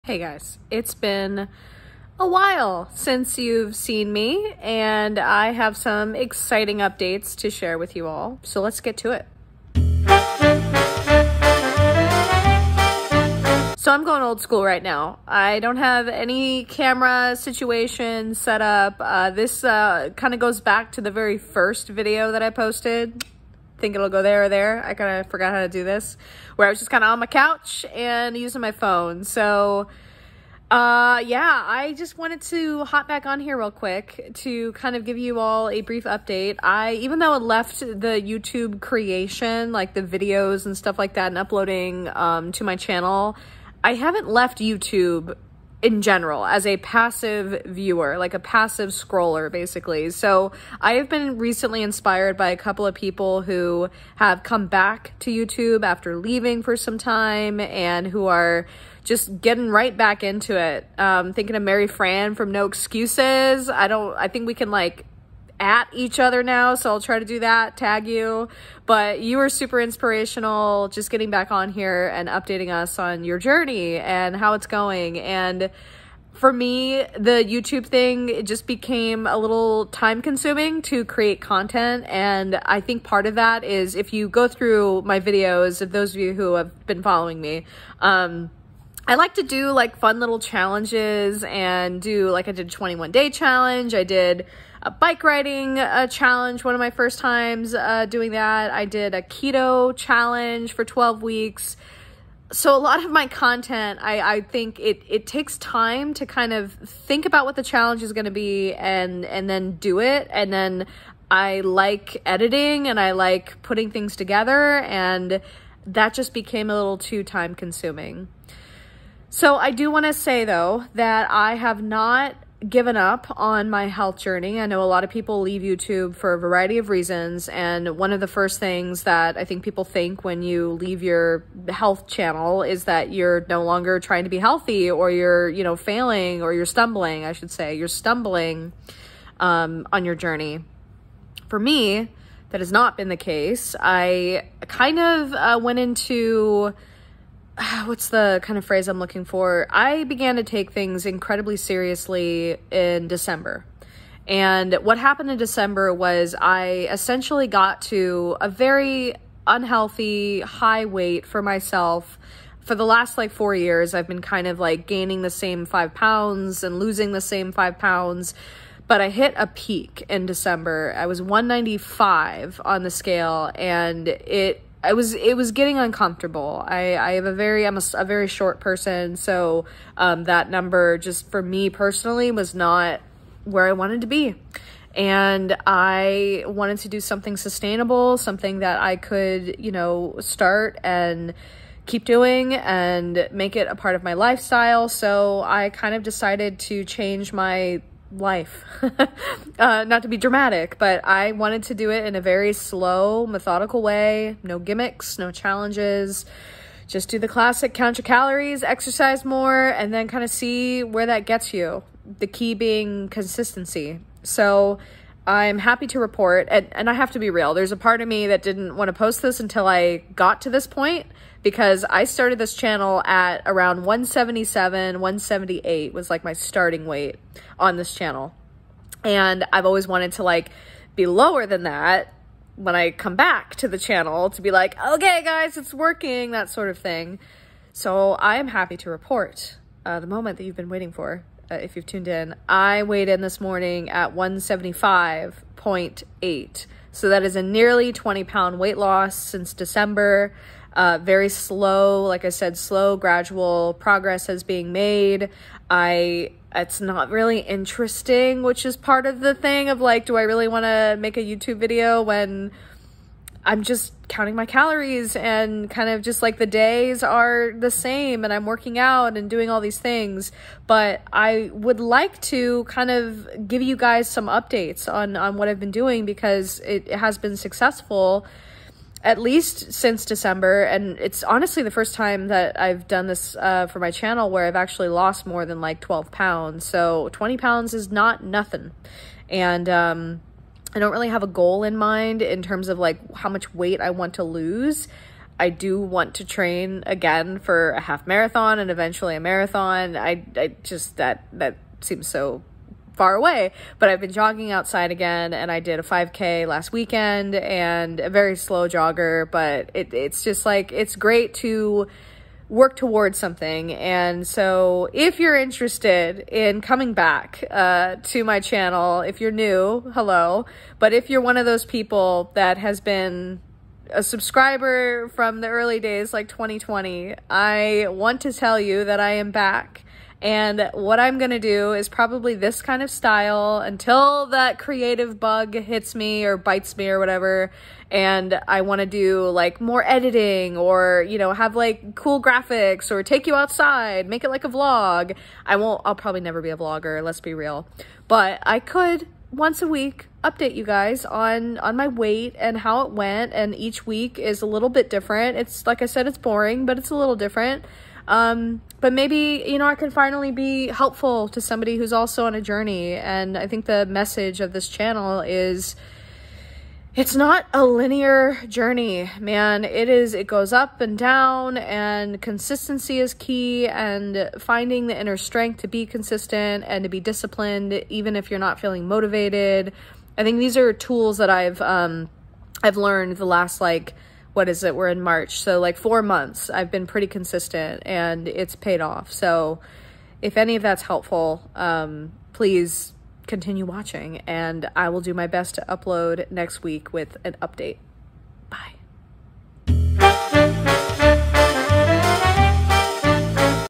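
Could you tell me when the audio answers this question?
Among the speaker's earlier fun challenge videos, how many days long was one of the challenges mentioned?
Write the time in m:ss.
1:32.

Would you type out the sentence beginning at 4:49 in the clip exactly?
And, um, I don't really have a goal in mind in terms of like how much weight I want to lose.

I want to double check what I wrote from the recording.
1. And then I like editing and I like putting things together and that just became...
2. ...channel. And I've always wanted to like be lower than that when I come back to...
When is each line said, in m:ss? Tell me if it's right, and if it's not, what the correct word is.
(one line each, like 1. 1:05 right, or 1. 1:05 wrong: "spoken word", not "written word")
1. 1:50 right
2. 3:47 right.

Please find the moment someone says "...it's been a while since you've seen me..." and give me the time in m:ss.
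0:00.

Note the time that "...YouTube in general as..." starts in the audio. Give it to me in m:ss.
0:44.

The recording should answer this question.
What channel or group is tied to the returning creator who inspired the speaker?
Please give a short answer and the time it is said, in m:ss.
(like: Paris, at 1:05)
No Excuses, at 1:02.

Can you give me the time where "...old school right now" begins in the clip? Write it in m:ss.
0:14.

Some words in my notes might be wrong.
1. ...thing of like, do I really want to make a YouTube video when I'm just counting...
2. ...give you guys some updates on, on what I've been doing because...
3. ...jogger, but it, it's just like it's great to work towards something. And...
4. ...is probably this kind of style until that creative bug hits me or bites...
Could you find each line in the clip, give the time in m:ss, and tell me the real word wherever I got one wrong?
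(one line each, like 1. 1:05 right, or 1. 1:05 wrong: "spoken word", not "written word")
1. 4:19 right
2. 4:33 right
3. 5:08 right
4. 5:31 right.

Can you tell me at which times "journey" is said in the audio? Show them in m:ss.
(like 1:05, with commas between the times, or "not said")
1:13, 2:04, 2:20, 6:02, 6:08.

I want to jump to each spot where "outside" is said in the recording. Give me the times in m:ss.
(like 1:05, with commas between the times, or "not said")
5:04, 5:43.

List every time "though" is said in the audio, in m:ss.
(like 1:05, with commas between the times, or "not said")
0:37, 2:00.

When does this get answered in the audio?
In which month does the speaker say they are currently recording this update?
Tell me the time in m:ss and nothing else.
6:25.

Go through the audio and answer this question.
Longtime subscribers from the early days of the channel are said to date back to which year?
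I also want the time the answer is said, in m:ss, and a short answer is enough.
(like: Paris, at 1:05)
2020, at 5:26.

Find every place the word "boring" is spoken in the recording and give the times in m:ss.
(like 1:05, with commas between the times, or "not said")
5:56.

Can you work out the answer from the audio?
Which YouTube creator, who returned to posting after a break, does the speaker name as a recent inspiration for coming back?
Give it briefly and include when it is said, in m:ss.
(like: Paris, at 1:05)
Mary Fran, at 1:01.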